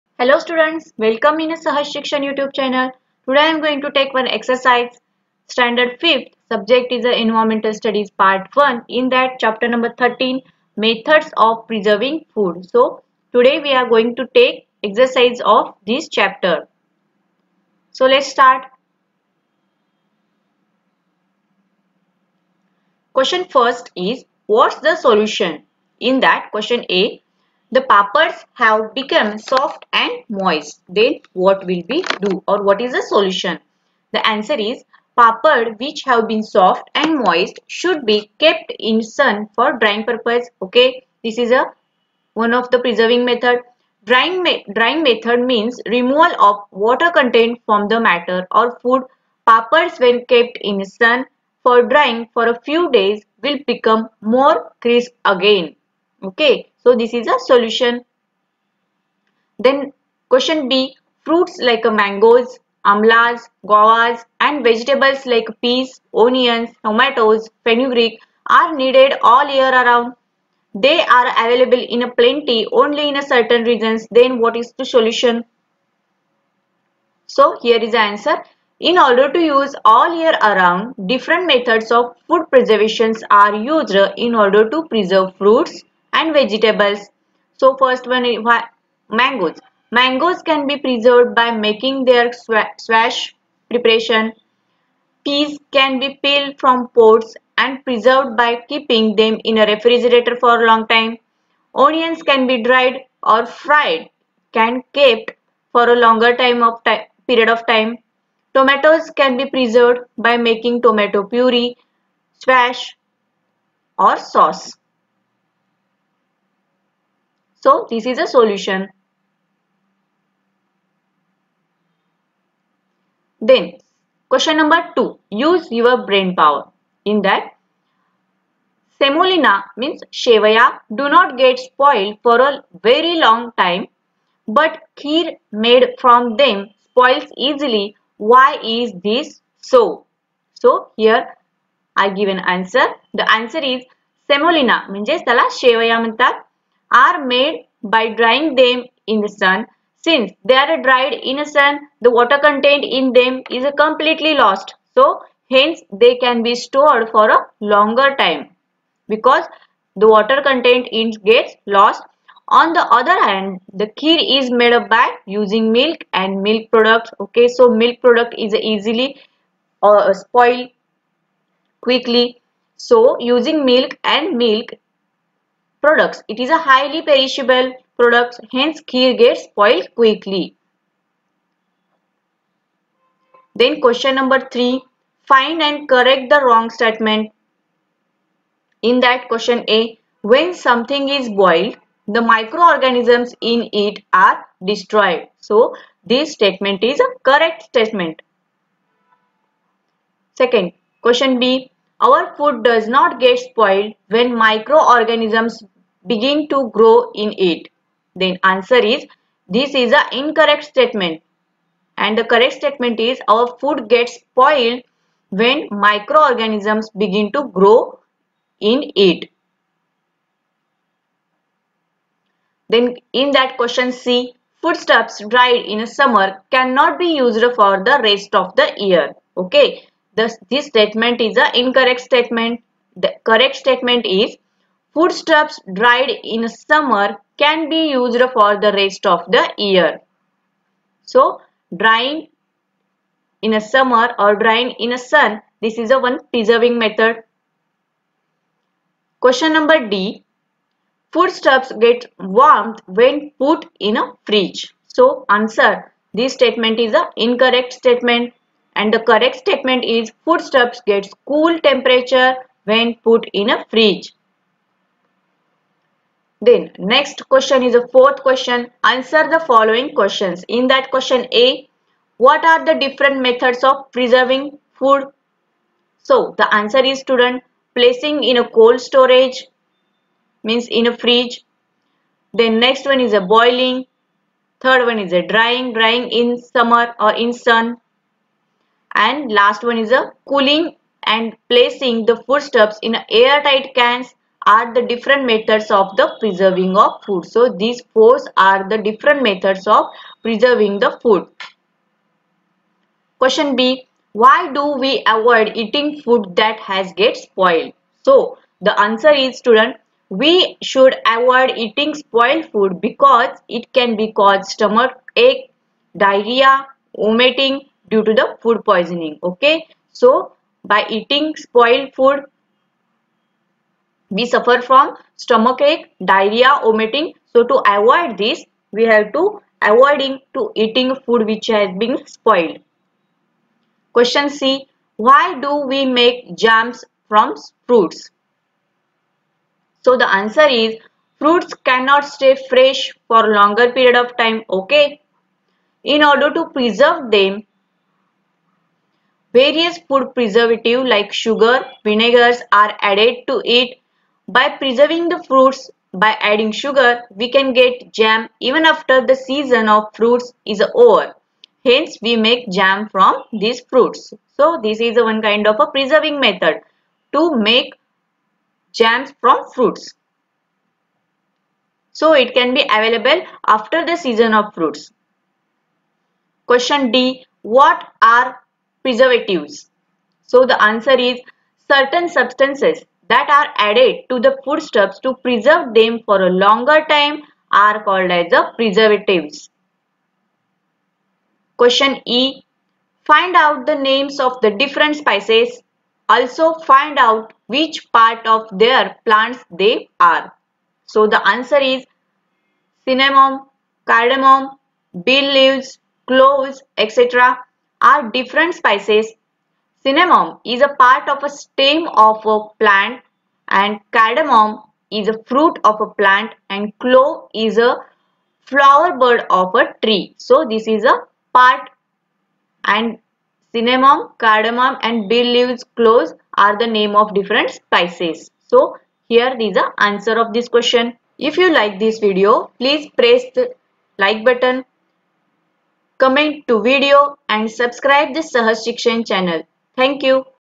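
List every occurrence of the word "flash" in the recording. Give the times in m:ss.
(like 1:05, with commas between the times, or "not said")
not said.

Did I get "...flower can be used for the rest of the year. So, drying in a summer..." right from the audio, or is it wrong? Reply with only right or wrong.
wrong.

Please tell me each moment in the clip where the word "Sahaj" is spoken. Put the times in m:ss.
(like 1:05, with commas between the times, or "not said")
0:01, 7:18.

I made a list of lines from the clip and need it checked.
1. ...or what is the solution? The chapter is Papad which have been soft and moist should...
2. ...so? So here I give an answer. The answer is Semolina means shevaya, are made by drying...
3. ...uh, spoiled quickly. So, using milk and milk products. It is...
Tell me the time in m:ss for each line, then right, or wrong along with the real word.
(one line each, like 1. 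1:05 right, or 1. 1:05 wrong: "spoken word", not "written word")
1. 0:32 wrong: "answer", not "chapter"
2. 2:19 right
3. 2:49 right.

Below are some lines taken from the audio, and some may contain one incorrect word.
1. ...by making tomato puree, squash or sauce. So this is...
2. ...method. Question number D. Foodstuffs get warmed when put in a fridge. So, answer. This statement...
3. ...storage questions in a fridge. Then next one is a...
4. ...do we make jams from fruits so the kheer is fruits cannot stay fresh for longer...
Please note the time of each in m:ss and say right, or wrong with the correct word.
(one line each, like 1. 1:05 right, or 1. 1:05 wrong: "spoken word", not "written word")
1. 1:50 right
2. 4:06 right
3. 4:38 wrong: "means", not "questions"
4. 5:35 wrong: "answer", not "kheer".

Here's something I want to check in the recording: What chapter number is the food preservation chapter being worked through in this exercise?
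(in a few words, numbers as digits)
13.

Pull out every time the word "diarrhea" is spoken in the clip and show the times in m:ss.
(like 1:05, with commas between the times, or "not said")
5:15, 5:26.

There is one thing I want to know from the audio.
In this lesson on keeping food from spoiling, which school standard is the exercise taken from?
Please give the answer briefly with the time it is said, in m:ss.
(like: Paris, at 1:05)
5th, at 0:05.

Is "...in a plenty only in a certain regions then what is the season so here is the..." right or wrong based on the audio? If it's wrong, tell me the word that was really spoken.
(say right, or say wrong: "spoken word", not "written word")
wrong: "solution", not "season".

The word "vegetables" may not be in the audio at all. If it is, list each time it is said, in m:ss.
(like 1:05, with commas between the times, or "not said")
1:04, 1:26.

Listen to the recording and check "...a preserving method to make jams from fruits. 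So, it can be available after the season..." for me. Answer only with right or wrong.
right.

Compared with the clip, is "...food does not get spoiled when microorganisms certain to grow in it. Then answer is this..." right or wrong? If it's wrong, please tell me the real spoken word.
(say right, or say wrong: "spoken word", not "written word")
wrong: "begin", not "certain".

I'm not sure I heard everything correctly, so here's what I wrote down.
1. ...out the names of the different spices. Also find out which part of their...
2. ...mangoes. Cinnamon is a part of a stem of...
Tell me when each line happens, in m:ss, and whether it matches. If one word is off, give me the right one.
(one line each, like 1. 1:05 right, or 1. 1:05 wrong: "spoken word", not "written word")
1. 6:33 right
2. 6:48 wrong: "spices", not "mangoes".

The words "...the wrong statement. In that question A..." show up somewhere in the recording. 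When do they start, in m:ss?
3:06.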